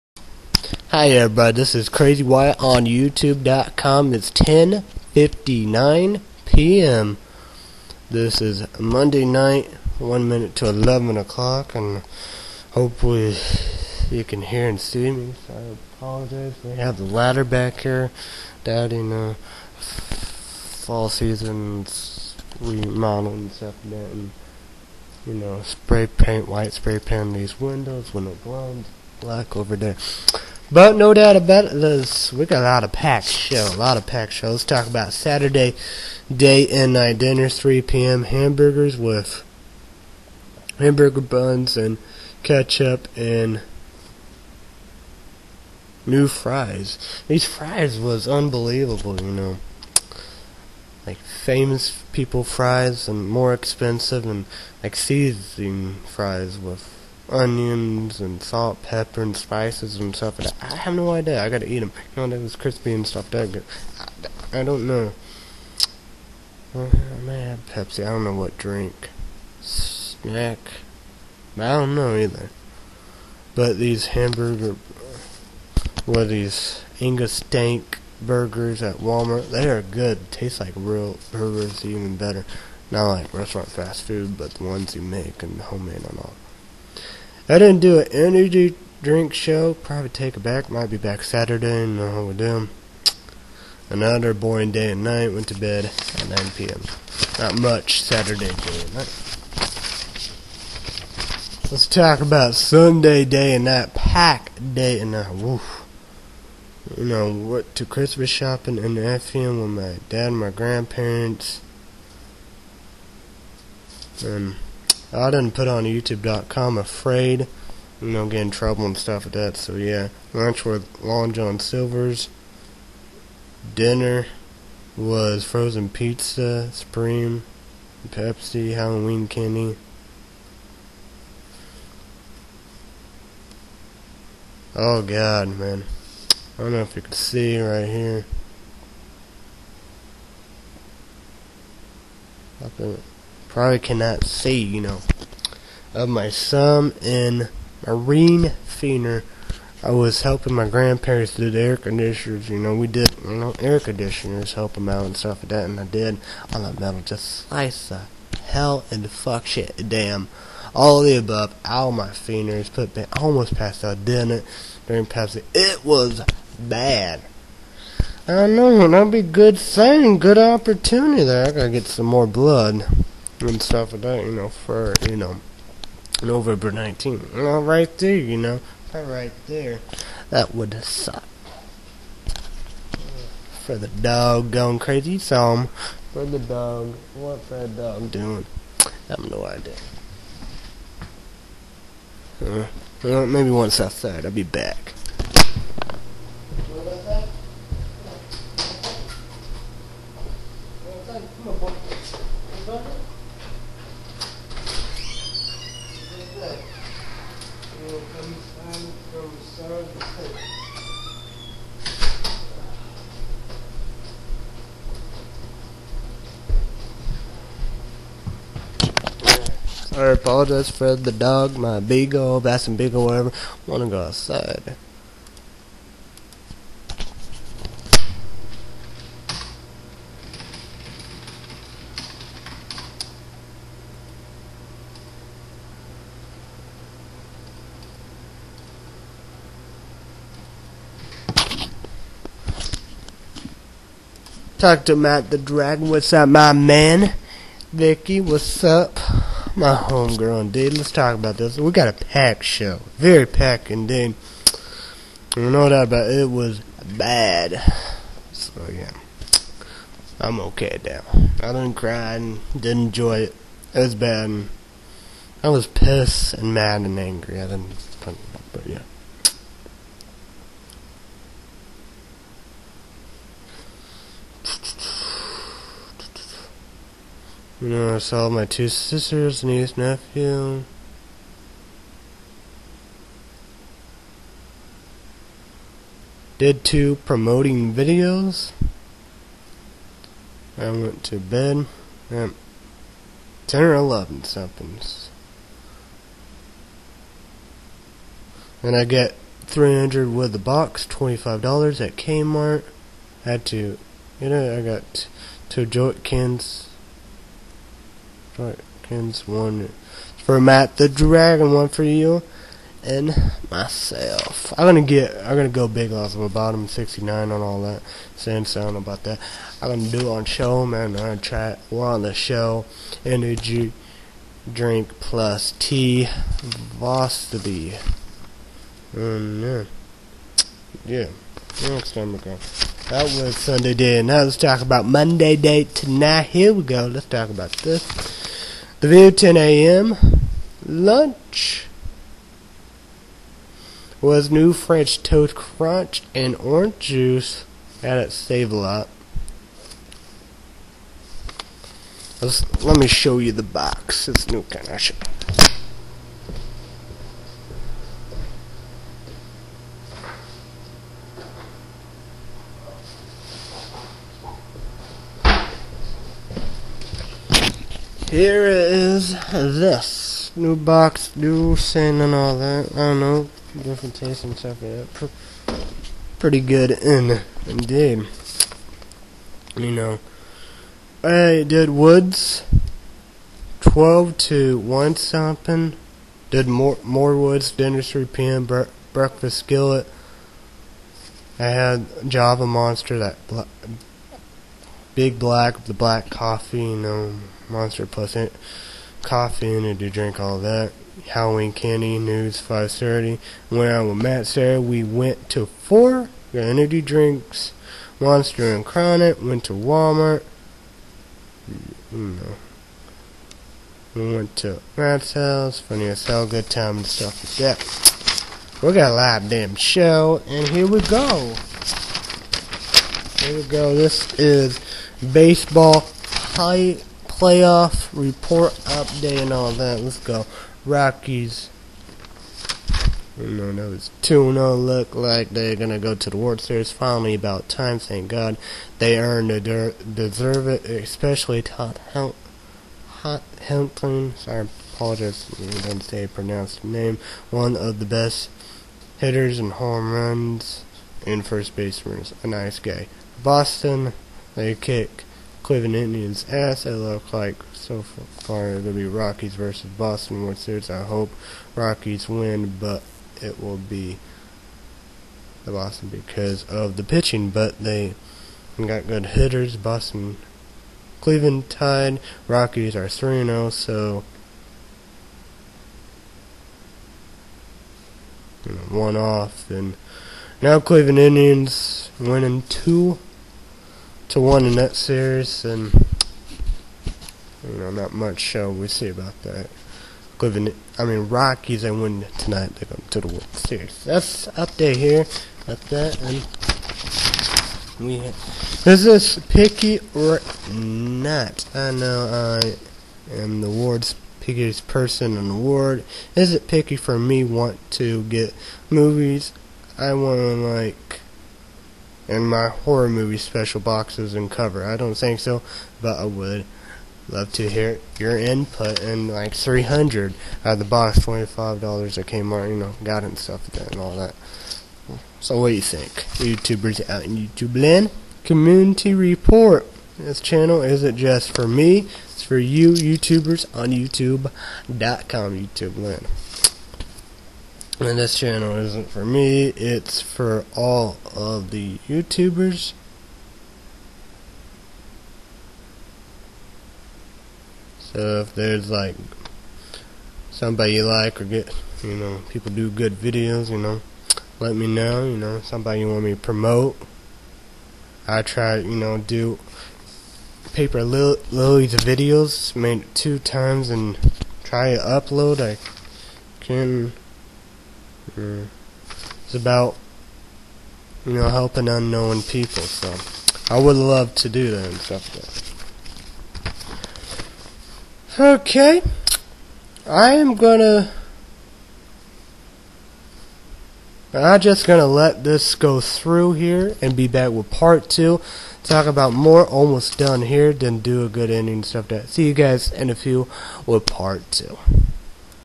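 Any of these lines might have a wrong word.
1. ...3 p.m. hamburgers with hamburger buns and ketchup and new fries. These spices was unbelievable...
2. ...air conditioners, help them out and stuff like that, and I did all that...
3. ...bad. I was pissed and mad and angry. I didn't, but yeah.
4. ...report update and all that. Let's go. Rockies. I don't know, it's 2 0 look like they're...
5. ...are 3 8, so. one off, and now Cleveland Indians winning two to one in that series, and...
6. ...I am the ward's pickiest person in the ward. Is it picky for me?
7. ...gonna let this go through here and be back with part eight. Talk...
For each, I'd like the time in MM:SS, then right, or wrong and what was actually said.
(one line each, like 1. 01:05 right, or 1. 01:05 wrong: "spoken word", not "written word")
1. 00:37 wrong: "fries", not "spices"
2. 02:33 right
3. 04:23 right
4. 07:07 right
5. 07:52 wrong: "0", not "8"
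6. 08:22 right
7. 09:44 wrong: "two", not "eight".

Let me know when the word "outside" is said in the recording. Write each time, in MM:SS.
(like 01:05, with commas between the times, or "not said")
03:13, 03:44.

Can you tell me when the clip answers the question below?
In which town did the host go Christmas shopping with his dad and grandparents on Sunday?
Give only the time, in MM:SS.
01:49.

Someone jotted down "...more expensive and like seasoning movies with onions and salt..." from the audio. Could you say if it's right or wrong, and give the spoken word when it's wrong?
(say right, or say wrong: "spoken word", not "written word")
wrong: "fries", not "movies".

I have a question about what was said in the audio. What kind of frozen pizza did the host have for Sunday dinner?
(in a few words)
Supreme.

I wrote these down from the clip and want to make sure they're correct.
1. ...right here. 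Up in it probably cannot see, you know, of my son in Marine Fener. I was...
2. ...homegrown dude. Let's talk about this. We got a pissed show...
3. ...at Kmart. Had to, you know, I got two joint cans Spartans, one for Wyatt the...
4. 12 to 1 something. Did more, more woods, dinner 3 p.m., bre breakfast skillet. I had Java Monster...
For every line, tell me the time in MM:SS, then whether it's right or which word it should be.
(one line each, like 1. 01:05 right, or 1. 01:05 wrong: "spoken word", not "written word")
1. 02:17 right
2. 04:09 wrong: "packed", not "pissed"
3. 05:01 wrong: "Matt", not "Wyatt"
4. 06:23 right.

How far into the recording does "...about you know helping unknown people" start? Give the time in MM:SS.
09:29.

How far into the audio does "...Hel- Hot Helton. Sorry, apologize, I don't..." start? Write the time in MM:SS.
07:21.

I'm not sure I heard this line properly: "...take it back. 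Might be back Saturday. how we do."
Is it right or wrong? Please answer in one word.
right.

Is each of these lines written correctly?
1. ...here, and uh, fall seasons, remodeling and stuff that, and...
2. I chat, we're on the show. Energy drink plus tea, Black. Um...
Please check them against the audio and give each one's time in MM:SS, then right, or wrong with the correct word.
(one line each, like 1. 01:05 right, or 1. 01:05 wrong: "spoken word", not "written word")
1. 00:17 right
2. 05:20 wrong: "Vostaby", not "Black".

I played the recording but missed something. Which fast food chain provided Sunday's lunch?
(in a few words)
Long John Silver's.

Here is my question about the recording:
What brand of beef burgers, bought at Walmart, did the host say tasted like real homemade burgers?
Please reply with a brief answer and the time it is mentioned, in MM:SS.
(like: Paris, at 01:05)
Angus, at 01:17.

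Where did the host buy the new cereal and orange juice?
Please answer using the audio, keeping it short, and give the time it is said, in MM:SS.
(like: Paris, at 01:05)
Save A Lot, at 05:48.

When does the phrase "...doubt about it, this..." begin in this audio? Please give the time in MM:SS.
00:31.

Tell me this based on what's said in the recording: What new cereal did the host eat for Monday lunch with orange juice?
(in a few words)
French Toast Crunch.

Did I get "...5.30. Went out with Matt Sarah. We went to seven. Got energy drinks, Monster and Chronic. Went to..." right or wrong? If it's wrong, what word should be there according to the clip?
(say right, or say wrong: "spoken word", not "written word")
wrong: "four", not "seven".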